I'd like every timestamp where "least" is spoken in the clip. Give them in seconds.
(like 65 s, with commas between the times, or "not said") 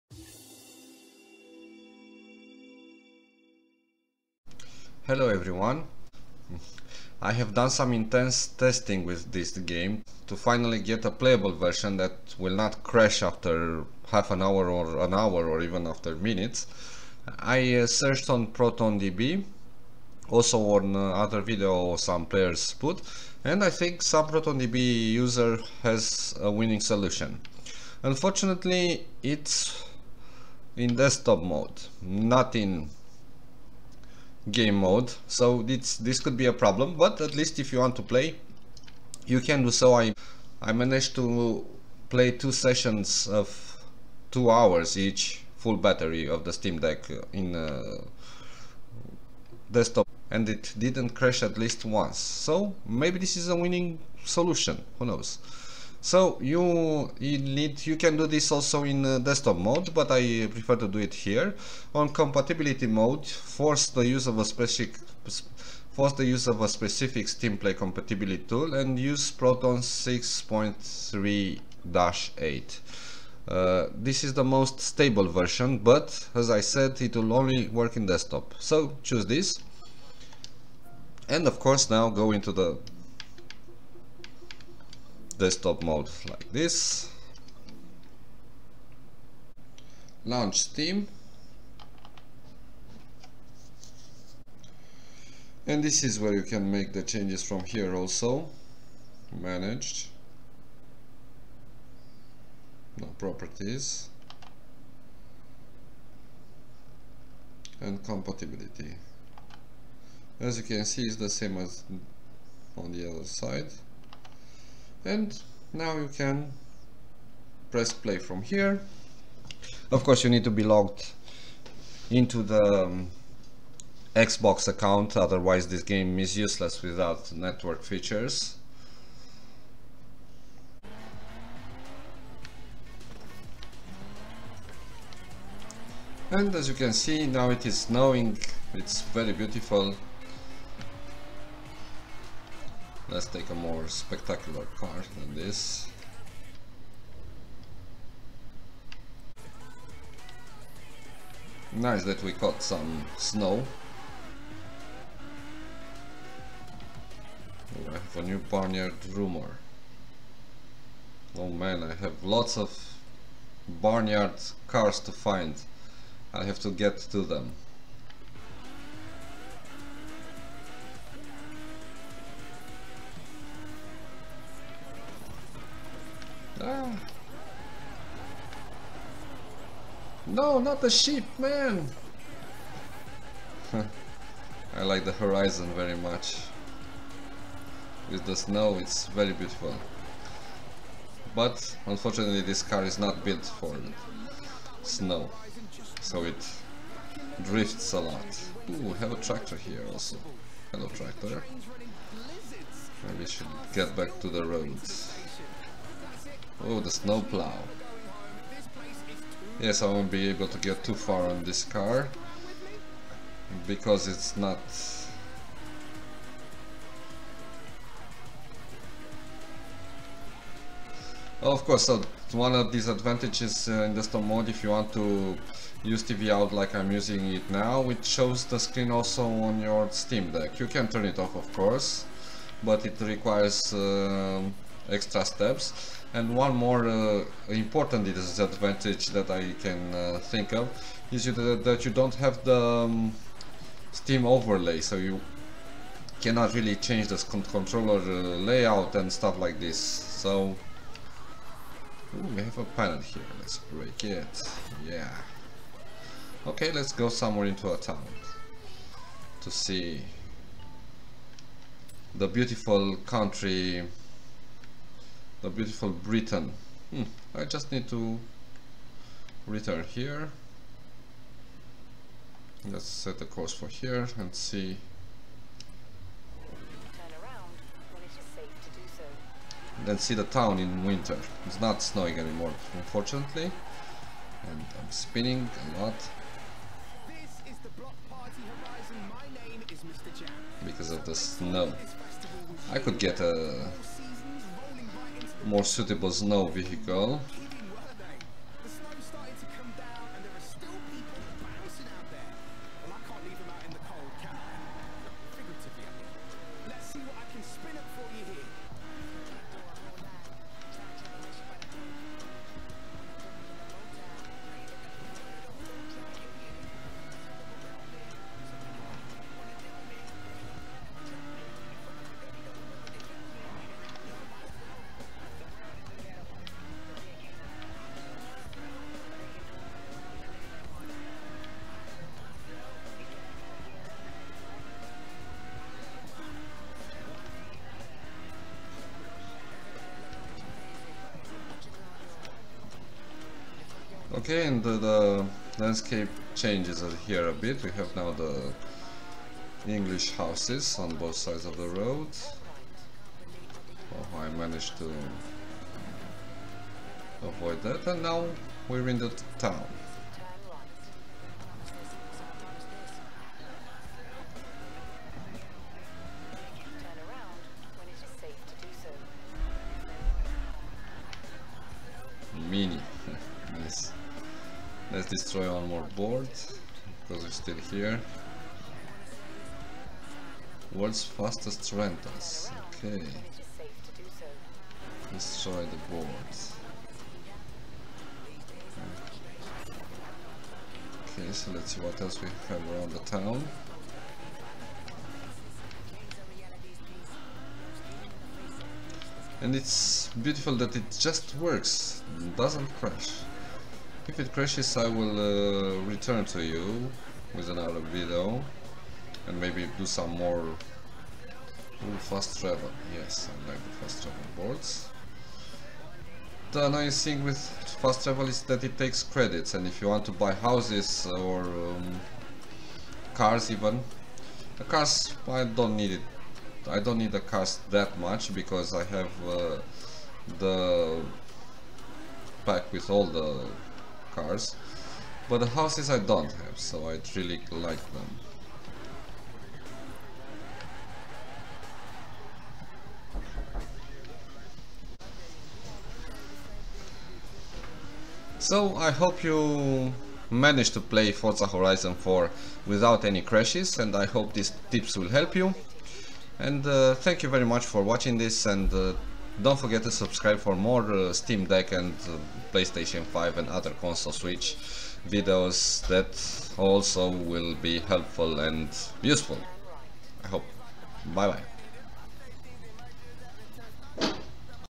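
37 s, 51 s.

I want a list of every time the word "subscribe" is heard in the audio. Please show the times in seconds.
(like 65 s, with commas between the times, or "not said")
459 s.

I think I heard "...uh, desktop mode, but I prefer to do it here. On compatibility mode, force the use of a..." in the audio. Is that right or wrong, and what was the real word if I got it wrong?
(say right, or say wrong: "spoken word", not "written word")
right.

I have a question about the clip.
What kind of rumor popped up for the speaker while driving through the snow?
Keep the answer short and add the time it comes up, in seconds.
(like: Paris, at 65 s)
barn find rumor, at 158 s.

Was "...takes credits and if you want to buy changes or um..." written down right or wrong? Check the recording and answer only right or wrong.
wrong.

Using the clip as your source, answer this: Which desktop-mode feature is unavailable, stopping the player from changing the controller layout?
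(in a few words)
Steam overlay.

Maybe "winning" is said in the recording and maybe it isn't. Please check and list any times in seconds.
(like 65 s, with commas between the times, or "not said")
26 s, 53 s.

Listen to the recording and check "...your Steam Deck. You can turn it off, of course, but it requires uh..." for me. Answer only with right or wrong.
right.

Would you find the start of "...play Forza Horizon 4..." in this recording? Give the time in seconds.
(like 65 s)
450 s.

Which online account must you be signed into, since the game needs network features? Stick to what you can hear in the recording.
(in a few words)
Xbox account.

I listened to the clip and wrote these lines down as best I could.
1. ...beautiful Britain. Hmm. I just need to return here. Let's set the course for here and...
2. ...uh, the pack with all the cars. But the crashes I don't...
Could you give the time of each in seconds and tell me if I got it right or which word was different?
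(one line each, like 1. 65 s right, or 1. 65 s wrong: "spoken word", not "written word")
1. 265 s right
2. 429 s wrong: "houses", not "crashes".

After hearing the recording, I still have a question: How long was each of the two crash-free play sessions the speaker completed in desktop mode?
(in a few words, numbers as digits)
2 hours.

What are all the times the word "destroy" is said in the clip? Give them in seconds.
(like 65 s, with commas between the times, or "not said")
375 s, 385 s.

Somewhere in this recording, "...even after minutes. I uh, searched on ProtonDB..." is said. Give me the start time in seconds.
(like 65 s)
15 s.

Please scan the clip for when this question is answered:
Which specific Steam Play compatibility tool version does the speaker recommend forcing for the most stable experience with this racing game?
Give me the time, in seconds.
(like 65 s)
69 s.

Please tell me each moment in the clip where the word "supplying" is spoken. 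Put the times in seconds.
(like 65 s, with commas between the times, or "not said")
not said.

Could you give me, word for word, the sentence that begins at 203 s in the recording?
Maybe should get back to the roads.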